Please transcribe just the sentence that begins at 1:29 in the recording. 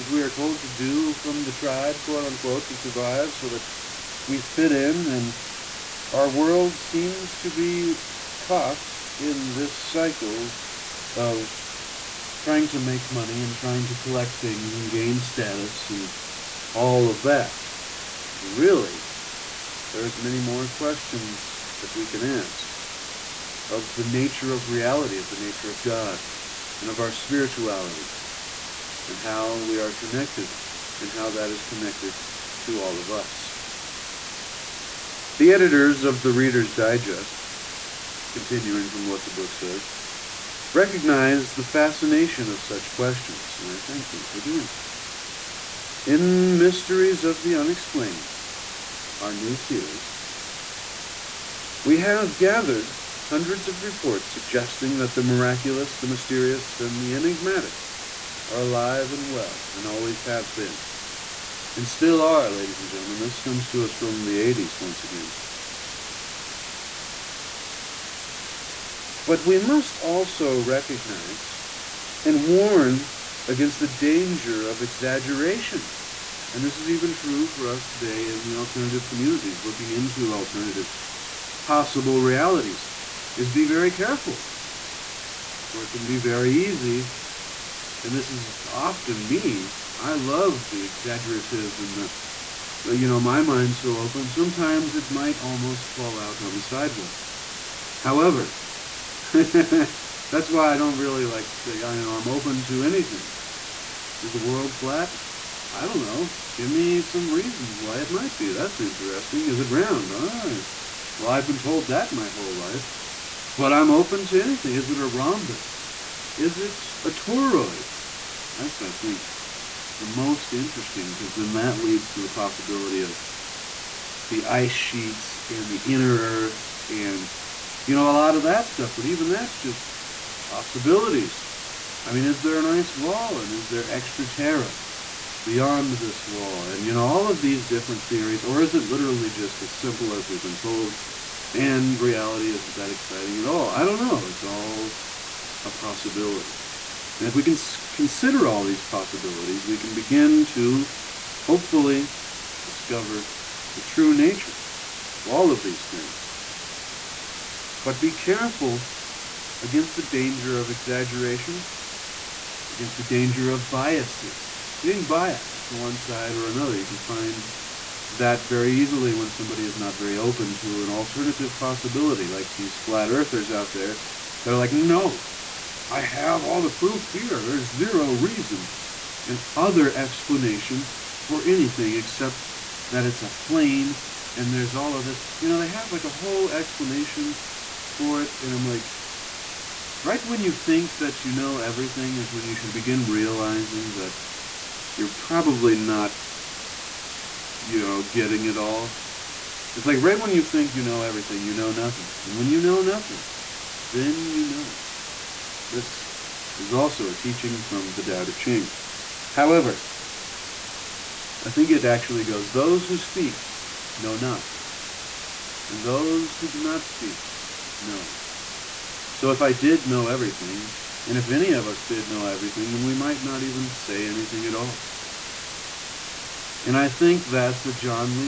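I love the exaggerative and the, the you know, my mind's so open.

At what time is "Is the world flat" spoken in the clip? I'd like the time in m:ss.
1:44.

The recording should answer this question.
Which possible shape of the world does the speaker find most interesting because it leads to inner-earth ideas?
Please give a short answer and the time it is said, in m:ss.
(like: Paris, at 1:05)
A toroid, at 1:57.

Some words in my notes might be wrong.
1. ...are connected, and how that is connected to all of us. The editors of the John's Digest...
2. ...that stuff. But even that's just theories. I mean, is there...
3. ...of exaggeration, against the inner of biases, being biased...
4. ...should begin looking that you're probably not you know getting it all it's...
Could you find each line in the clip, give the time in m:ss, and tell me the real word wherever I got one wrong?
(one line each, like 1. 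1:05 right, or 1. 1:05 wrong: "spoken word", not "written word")
1. 0:29 wrong: "Reader", not "John"
2. 2:08 wrong: "possibilities", not "theories"
3. 2:40 wrong: "danger", not "inner"
4. 3:12 wrong: "realizing", not "looking".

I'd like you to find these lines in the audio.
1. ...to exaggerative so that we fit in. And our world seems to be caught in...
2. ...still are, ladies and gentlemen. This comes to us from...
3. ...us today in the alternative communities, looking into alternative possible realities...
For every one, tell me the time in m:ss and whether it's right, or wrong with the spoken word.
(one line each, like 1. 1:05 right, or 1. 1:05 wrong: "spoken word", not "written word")
1. 0:02 wrong: "survive", not "exaggerative"
2. 1:01 right
3. 1:17 right.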